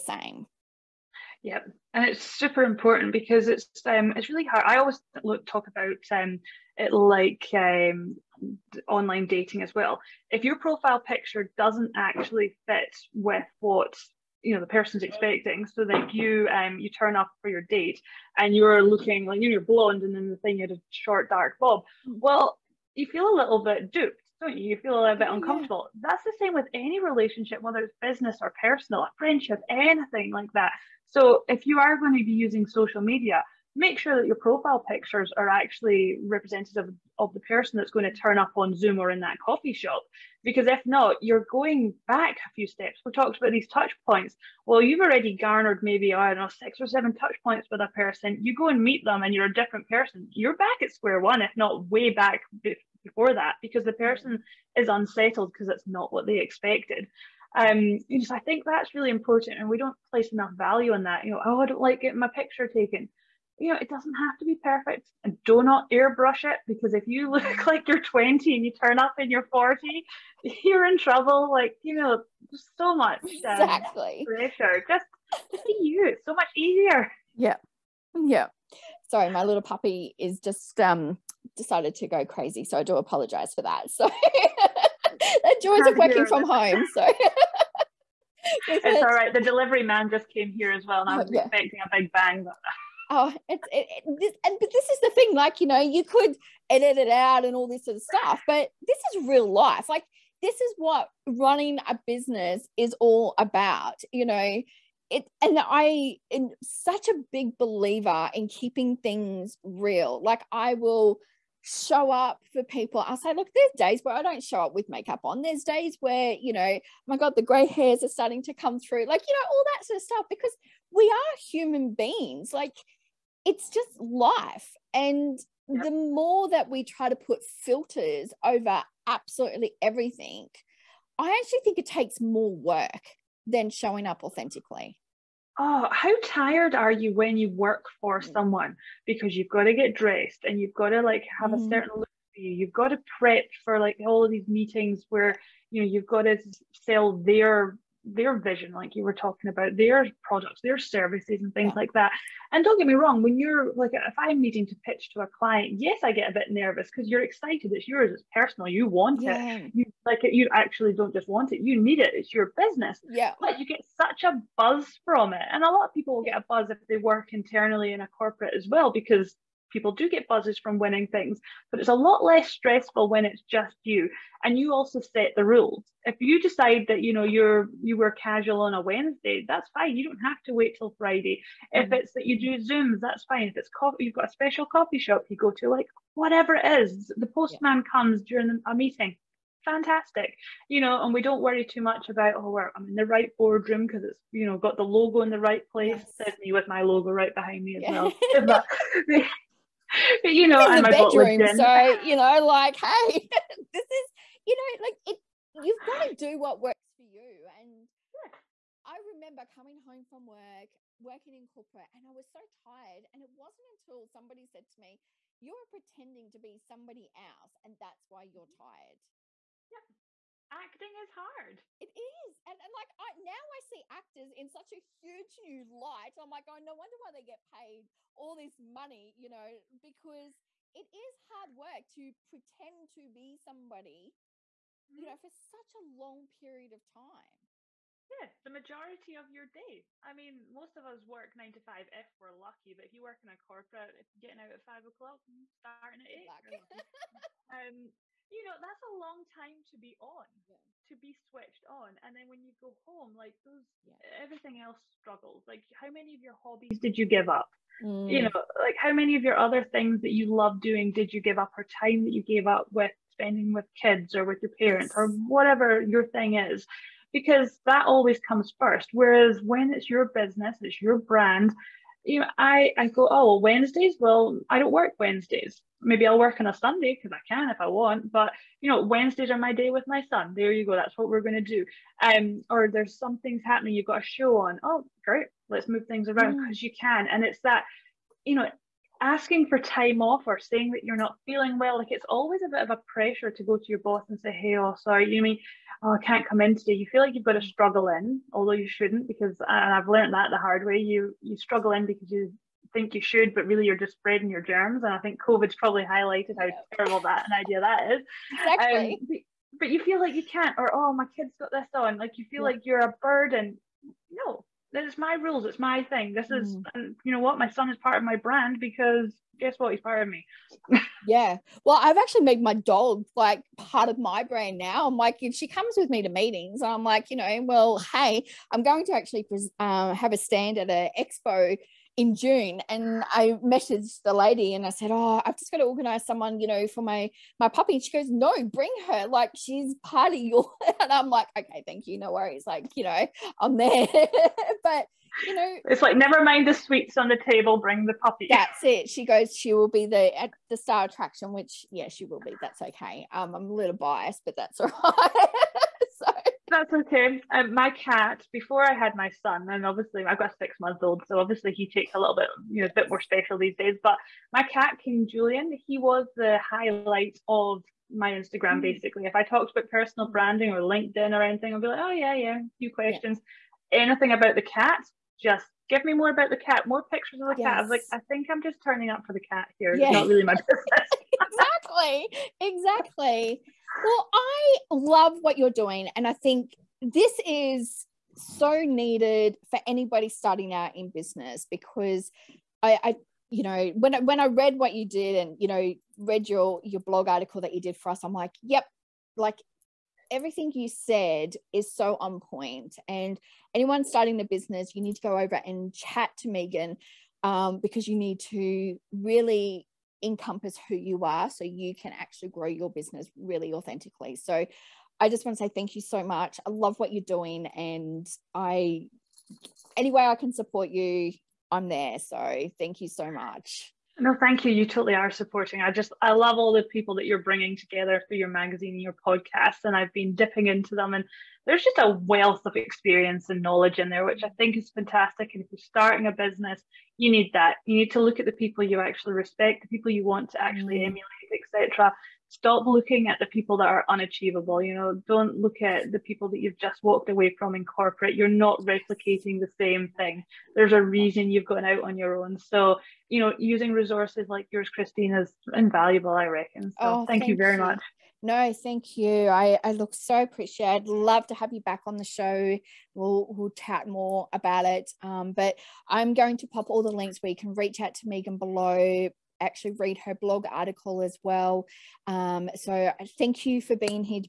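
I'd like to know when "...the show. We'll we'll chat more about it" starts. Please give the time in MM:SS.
07:41.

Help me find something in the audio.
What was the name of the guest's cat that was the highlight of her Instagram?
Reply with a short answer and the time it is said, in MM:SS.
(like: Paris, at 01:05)
King Julian, at 06:04.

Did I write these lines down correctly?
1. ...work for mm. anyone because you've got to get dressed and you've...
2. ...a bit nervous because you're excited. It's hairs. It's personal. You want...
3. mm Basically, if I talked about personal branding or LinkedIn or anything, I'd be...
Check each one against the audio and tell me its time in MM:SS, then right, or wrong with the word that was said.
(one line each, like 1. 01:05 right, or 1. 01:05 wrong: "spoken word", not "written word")
1. 02:17 wrong: "someone", not "anyone"
2. 02:36 wrong: "yours", not "hairs"
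3. 06:08 right.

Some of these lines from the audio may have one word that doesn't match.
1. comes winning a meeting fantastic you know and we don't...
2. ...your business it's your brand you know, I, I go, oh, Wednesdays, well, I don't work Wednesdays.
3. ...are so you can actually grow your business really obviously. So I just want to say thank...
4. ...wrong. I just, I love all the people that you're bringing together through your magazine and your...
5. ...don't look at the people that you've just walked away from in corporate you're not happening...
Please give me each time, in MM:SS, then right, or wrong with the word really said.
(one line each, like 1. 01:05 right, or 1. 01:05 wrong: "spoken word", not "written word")
1. 03:07 wrong: "during", not "winning"
2. 04:29 right
3. 06:51 wrong: "authentically", not "obviously"
4. 07:05 wrong: "supporting", not "wrong"
5. 07:25 wrong: "replicating", not "happening".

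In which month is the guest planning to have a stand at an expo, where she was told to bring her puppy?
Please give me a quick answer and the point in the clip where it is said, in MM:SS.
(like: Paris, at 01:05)
June, at 05:32.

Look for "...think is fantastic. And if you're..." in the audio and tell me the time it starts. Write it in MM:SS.
07:14.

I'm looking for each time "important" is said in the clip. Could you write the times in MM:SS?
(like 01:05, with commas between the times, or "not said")
00:02, 00:59.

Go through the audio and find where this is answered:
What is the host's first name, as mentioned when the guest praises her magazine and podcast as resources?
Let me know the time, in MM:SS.
07:34.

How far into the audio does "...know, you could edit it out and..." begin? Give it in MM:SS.
01:35.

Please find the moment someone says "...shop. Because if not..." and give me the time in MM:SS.
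00:39.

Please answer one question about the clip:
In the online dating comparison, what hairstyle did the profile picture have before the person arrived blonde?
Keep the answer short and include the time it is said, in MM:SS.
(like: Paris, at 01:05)
Short dark bob, at 00:20.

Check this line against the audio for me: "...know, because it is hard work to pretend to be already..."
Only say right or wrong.
wrong.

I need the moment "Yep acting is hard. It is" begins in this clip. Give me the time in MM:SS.
03:39.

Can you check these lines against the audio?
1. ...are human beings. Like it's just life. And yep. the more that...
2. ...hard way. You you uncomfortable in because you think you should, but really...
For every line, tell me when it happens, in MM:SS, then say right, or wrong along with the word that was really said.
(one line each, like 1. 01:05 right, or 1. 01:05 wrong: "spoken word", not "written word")
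1. 02:01 right
2. 05:00 wrong: "struggle", not "uncomfortable".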